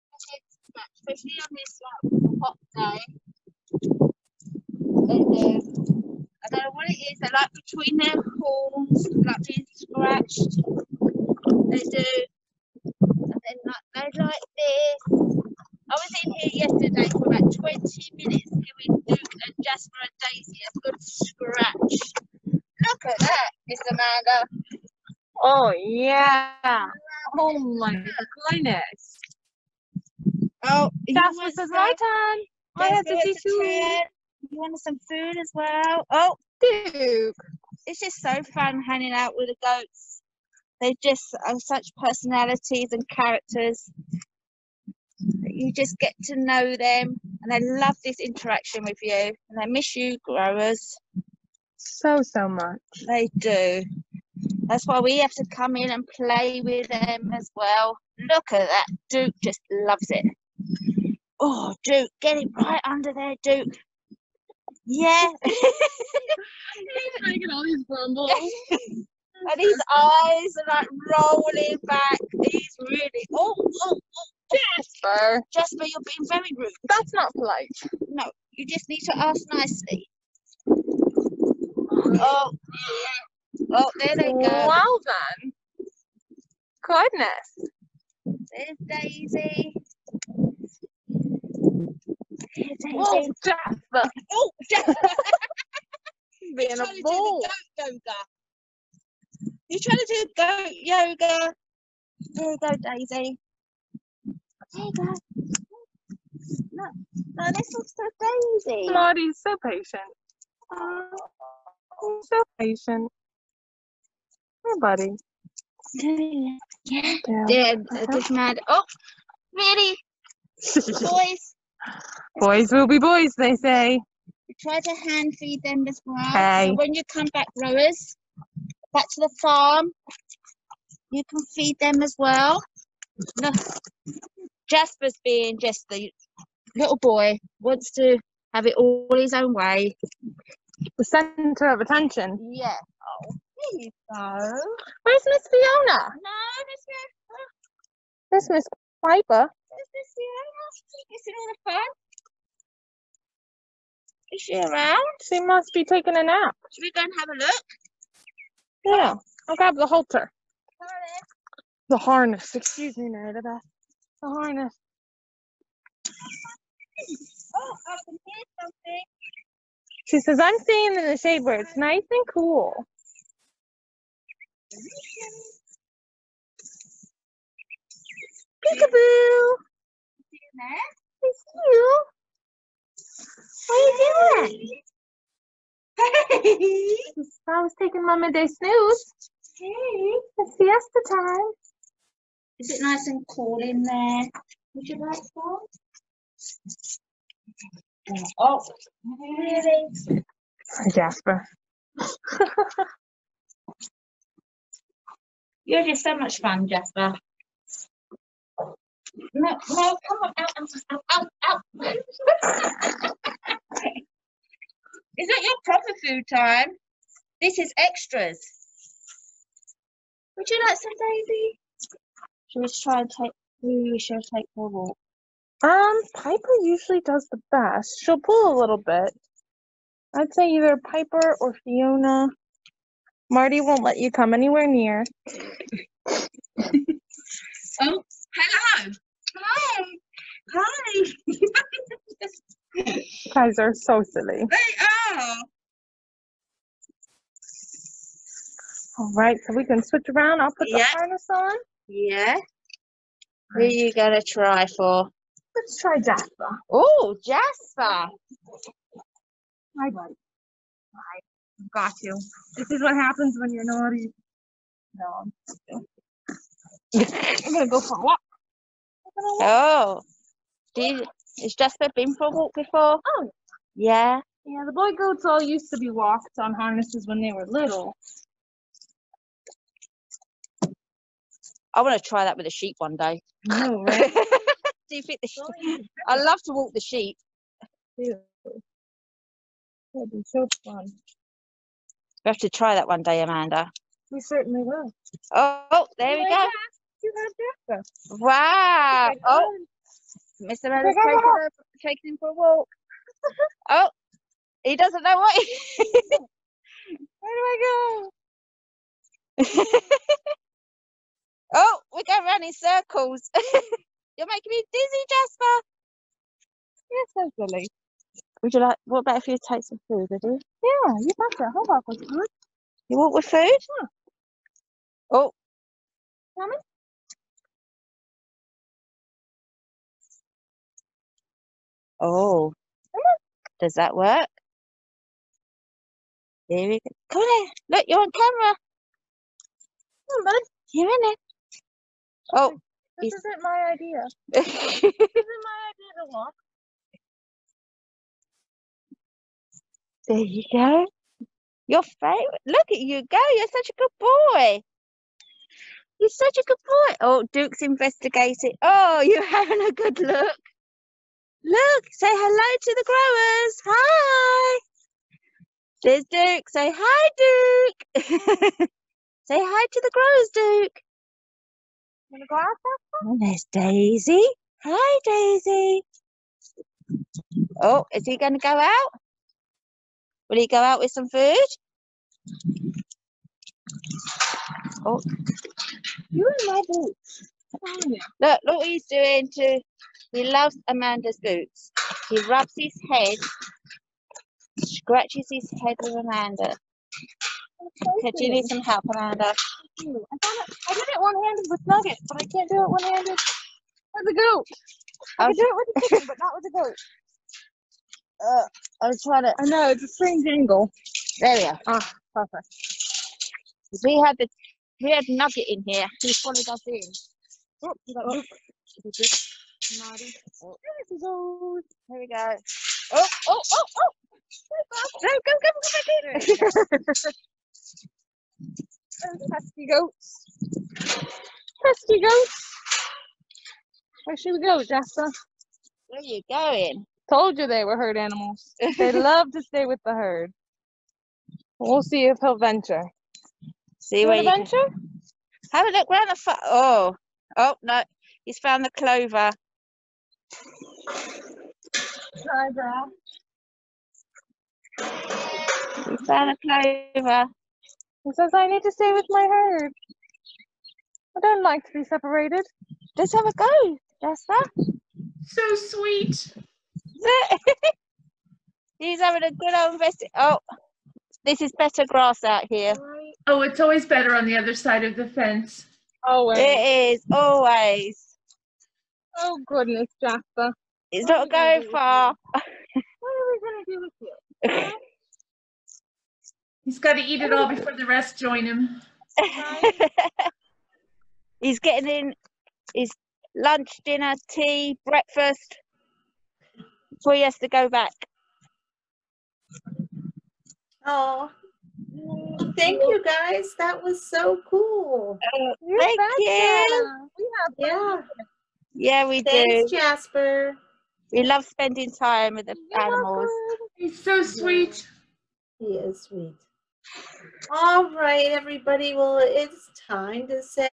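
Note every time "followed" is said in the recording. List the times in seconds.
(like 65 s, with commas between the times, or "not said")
416 s.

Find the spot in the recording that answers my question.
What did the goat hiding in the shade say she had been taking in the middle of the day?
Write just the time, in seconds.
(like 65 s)
188 s.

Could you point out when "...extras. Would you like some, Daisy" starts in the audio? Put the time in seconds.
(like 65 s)
217 s.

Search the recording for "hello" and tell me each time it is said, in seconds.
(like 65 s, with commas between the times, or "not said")
238 s, 362 s.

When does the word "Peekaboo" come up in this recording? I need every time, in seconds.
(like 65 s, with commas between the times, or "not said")
178 s.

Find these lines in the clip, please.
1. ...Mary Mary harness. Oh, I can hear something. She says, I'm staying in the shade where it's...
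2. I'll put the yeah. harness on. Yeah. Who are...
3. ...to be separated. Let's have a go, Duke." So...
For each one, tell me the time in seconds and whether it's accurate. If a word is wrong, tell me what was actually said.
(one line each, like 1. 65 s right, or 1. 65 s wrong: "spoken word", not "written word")
1. 163 s wrong: "The", not "Mary"
2. 250 s right
3. 461 s wrong: "Lester", not "Duke".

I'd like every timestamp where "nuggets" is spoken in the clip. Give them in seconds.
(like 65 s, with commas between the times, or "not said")
401 s, 415 s.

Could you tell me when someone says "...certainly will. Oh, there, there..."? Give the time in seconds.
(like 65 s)
294 s.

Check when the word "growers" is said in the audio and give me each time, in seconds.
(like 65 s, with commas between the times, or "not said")
50 s, 127 s, 362 s, 369 s.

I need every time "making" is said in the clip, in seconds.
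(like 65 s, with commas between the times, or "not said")
67 s, 314 s.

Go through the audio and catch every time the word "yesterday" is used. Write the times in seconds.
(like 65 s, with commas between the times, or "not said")
16 s.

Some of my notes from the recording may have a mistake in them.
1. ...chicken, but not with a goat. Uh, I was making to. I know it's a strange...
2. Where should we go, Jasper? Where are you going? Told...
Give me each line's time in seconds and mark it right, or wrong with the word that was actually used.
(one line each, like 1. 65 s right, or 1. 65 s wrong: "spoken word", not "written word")
1. 405 s wrong: "trying", not "making"
2. 434 s right.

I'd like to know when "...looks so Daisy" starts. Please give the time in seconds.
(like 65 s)
107 s.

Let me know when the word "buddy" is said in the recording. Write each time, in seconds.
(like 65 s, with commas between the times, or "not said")
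114 s, 259 s, 340 s.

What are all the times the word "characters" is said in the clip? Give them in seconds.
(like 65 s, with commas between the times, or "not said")
43 s.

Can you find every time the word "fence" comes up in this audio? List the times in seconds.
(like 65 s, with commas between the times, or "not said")
475 s.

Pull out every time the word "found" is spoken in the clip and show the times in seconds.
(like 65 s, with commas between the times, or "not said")
448 s, 456 s.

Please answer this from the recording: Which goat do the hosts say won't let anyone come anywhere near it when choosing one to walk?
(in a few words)
Marty.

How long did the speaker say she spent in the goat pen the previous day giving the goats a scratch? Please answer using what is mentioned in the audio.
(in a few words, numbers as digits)
20 minutes.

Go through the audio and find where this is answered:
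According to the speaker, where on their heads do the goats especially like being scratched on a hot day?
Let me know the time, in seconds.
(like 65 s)
7 s.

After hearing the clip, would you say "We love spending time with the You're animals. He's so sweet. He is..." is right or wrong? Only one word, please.
right.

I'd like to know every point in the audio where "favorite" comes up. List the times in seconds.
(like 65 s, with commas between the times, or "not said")
351 s.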